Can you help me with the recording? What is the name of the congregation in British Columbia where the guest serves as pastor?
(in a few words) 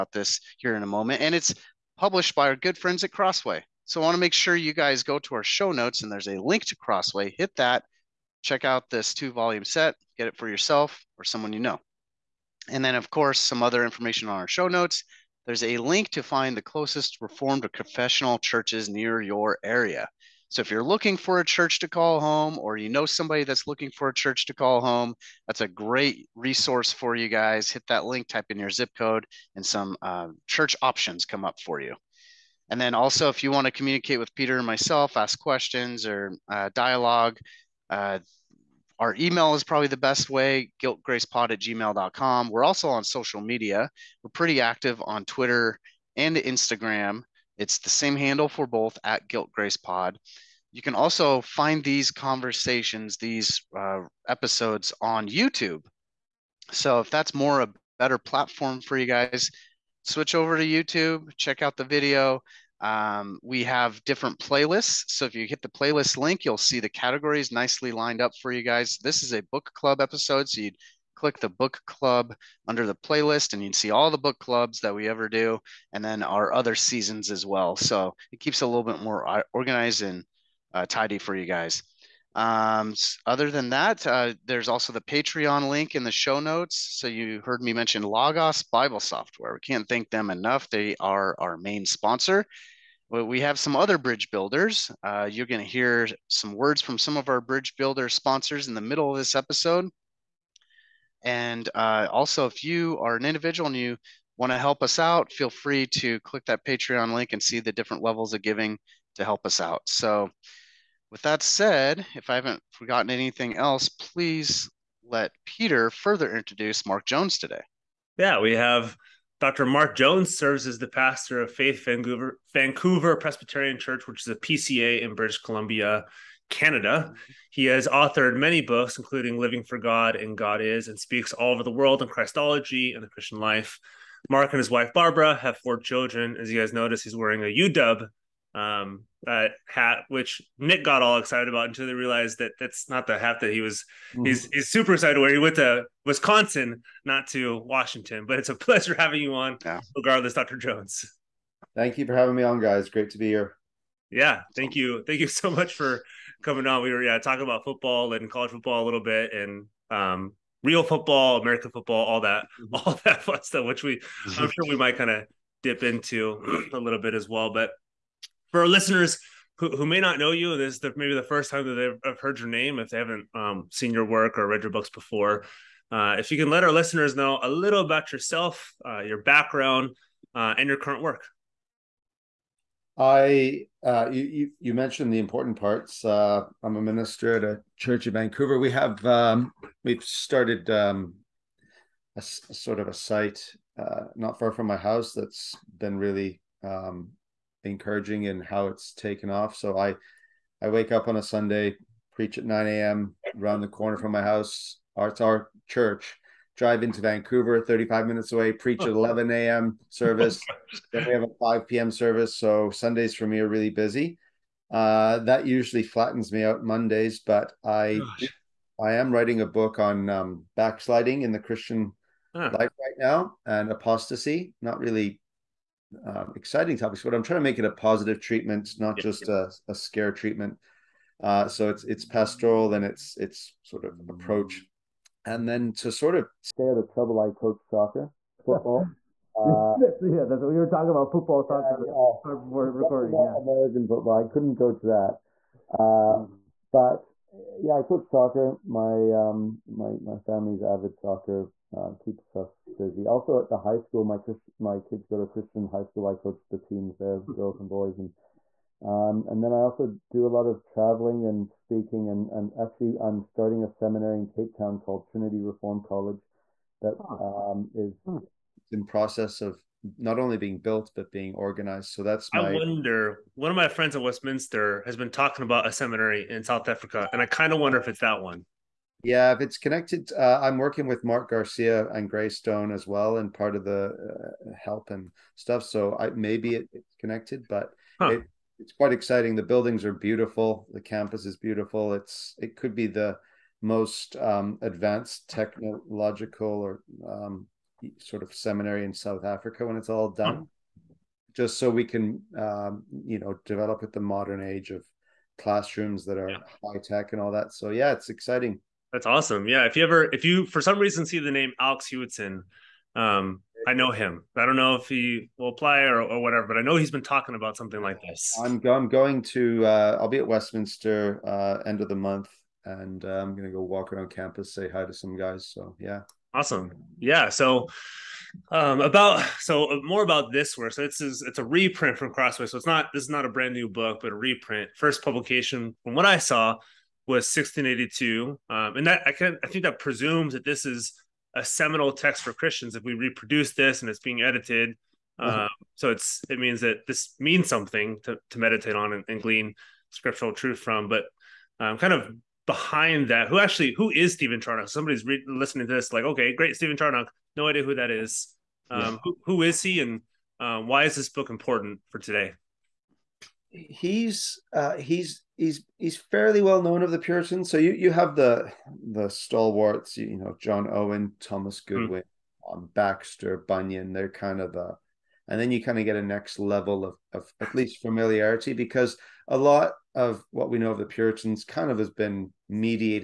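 Faith Vancouver.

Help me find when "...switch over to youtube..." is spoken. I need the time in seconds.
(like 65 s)
60 s.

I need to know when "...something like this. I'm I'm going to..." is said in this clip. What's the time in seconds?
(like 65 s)
317 s.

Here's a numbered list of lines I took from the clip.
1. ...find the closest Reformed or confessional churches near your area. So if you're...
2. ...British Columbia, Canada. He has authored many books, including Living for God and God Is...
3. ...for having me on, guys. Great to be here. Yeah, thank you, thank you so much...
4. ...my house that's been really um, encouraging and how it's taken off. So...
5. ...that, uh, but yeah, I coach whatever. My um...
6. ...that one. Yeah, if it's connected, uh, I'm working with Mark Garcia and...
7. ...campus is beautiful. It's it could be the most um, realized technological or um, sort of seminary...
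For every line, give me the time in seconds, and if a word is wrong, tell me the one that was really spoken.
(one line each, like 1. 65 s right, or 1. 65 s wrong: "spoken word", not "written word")
1. 16 s right
2. 125 s right
3. 152 s right
4. 194 s right
5. 244 s wrong: "soccer", not "whatever"
6. 277 s right
7. 290 s wrong: "advanced", not "realized".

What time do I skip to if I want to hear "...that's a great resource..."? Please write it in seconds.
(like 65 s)
25 s.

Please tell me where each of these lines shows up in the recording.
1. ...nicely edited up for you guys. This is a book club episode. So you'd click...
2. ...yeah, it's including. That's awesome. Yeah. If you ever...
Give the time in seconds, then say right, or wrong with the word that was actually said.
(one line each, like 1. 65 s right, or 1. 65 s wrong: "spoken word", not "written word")
1. 67 s wrong: "lined", not "edited"
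2. 307 s wrong: "exciting", not "including".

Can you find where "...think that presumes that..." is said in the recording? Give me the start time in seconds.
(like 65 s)
339 s.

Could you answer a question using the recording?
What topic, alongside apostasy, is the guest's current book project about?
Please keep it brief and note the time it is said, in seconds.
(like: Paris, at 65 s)
Backsliding, at 220 s.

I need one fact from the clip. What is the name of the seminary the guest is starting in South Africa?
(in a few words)
Trinity Reform College.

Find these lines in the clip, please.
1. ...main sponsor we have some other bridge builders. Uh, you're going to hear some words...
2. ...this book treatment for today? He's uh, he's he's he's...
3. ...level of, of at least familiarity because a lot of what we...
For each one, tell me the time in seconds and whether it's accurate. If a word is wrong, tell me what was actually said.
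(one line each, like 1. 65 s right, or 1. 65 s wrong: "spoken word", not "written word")
1. 91 s right
2. 360 s wrong: "important", not "treatment"
3. 376 s right.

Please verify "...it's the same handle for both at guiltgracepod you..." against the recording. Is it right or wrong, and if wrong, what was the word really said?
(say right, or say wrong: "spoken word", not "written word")
right.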